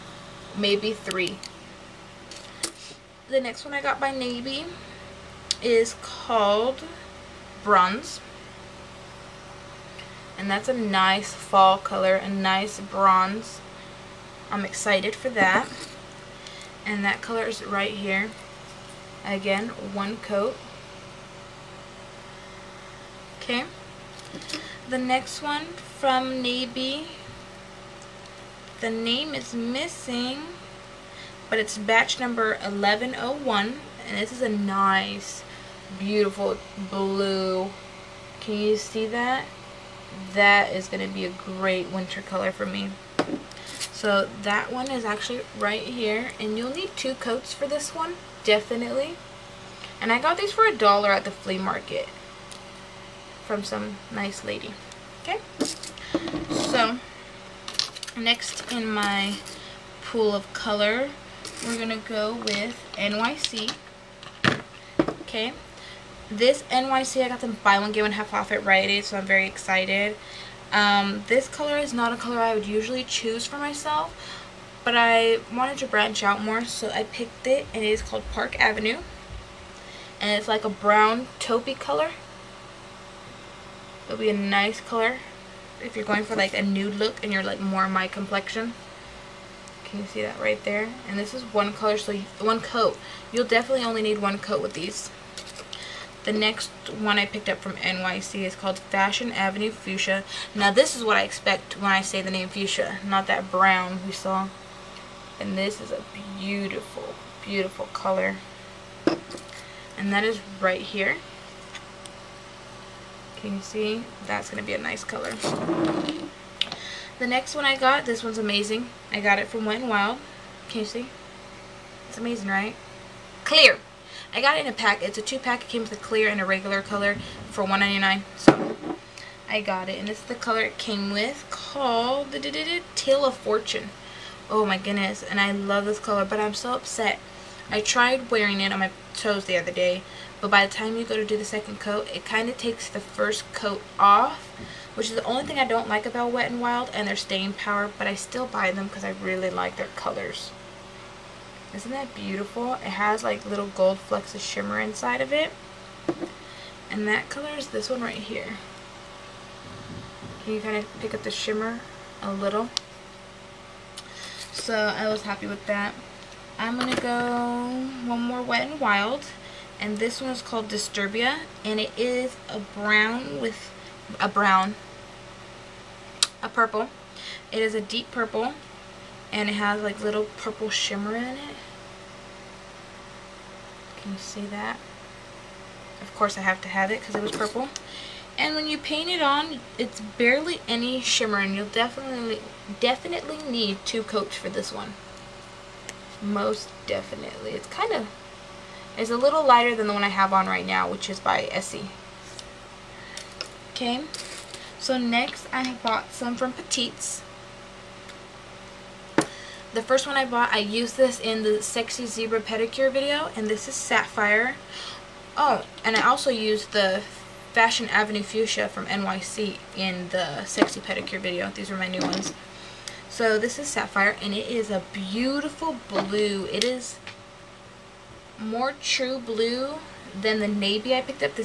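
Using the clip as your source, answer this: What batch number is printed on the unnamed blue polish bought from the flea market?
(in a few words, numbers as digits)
1101.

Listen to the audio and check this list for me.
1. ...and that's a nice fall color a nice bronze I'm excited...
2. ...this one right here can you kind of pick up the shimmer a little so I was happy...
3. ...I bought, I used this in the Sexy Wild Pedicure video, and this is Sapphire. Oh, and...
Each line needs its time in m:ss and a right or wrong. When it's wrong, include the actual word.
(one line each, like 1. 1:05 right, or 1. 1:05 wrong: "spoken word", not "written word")
1. 0:10 right
2. 2:37 right
3. 3:30 wrong: "Zebra", not "Wild".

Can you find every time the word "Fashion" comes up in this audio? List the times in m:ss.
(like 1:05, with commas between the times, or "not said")
1:38, 3:37.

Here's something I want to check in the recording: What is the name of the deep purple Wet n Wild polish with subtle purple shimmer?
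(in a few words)
Disturbia.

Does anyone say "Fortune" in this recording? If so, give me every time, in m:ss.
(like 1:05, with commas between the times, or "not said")
2:13.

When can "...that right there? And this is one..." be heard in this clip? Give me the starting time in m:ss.
1:30.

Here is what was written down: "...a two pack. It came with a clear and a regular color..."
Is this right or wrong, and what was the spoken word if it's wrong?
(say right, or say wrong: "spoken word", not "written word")
right.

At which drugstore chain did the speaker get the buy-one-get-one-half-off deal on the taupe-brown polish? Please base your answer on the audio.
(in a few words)
Rite Aid.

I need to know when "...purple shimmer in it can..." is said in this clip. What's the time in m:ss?
3:00.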